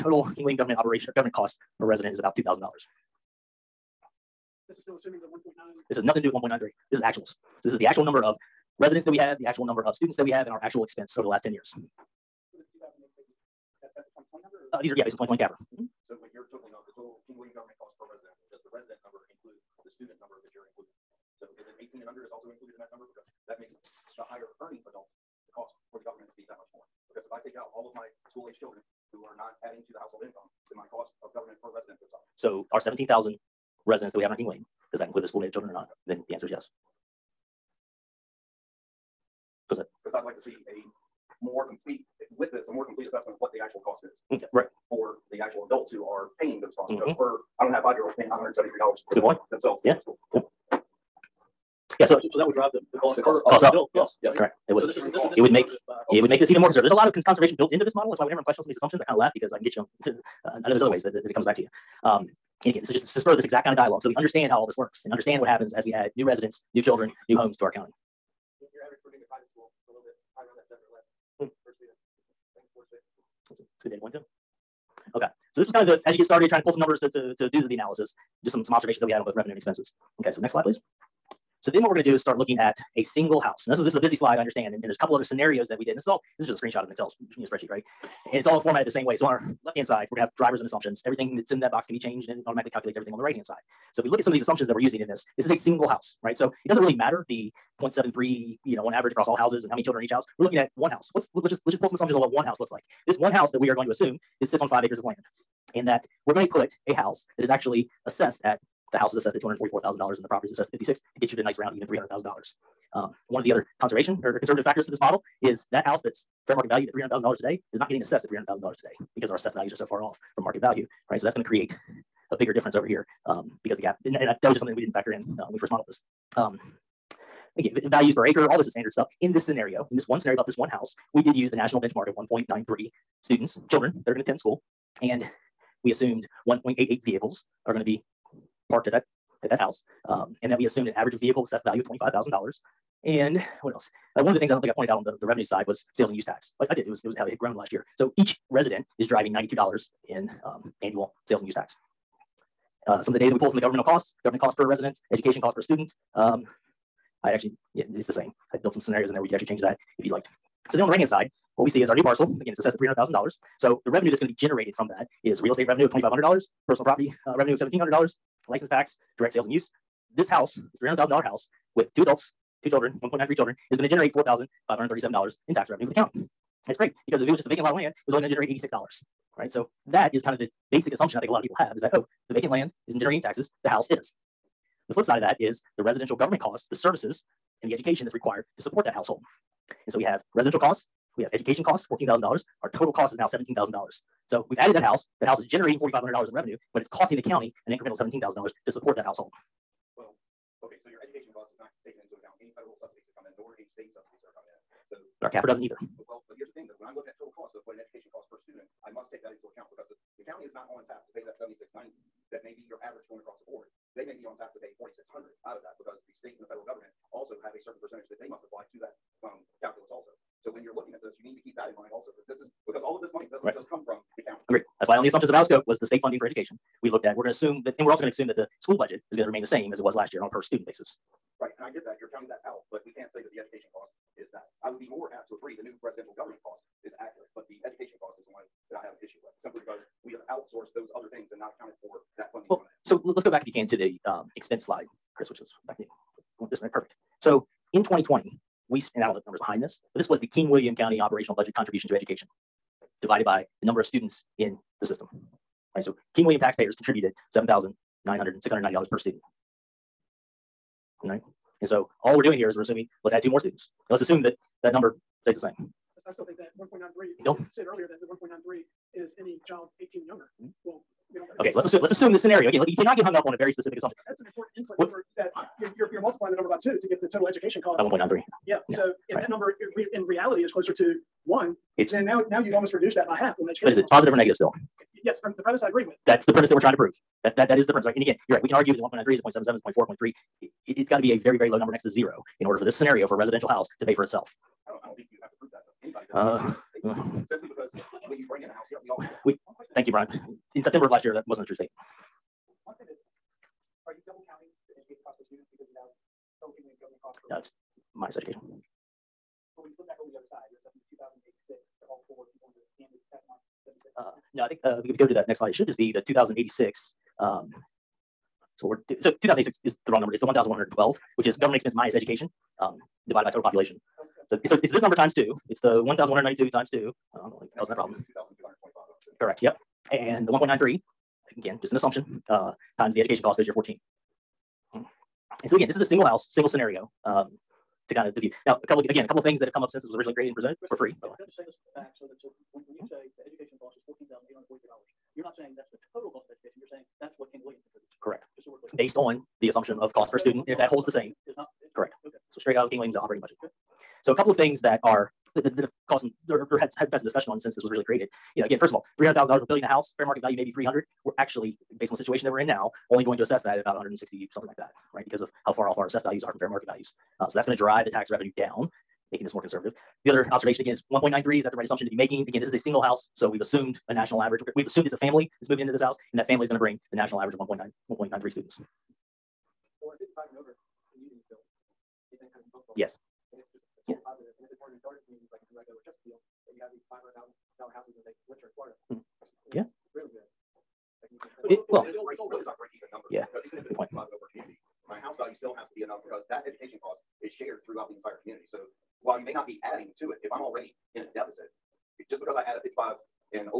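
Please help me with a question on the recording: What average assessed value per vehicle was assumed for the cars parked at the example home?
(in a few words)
$25,000.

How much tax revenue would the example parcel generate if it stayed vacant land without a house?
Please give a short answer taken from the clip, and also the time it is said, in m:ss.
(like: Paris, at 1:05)
$86, at 2:58.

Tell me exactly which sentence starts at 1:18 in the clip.
Just some some observations that we had on both revenue and expenses.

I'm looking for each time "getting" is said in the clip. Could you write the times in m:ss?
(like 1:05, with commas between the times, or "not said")
1:57.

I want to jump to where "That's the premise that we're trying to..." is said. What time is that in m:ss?
4:46.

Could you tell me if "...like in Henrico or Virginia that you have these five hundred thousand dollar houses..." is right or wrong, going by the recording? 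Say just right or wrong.
wrong.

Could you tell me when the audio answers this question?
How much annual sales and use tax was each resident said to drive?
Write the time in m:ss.
2:29.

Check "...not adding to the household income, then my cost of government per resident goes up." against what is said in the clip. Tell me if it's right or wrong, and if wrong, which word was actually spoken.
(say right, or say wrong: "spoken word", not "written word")
right.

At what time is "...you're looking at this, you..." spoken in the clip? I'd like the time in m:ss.
3:40.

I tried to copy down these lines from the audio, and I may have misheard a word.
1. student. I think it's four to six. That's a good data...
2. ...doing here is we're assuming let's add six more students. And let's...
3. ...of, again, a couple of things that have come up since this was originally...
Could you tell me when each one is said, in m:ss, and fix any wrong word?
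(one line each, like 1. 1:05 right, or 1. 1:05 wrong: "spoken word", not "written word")
1. 1:11 right
2. 4:22 wrong: "two", not "six"
3. 5:38 right.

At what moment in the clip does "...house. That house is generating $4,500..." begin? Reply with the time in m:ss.
3:14.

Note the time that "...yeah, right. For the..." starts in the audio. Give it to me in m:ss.
0:44.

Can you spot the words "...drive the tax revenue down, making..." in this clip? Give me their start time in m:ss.
6:07.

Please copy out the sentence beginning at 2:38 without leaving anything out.
I built some scenarios in there where we could actually change that if you'd like.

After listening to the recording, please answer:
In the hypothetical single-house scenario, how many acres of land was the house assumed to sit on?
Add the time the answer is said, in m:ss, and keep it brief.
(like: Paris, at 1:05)
5, at 1:44.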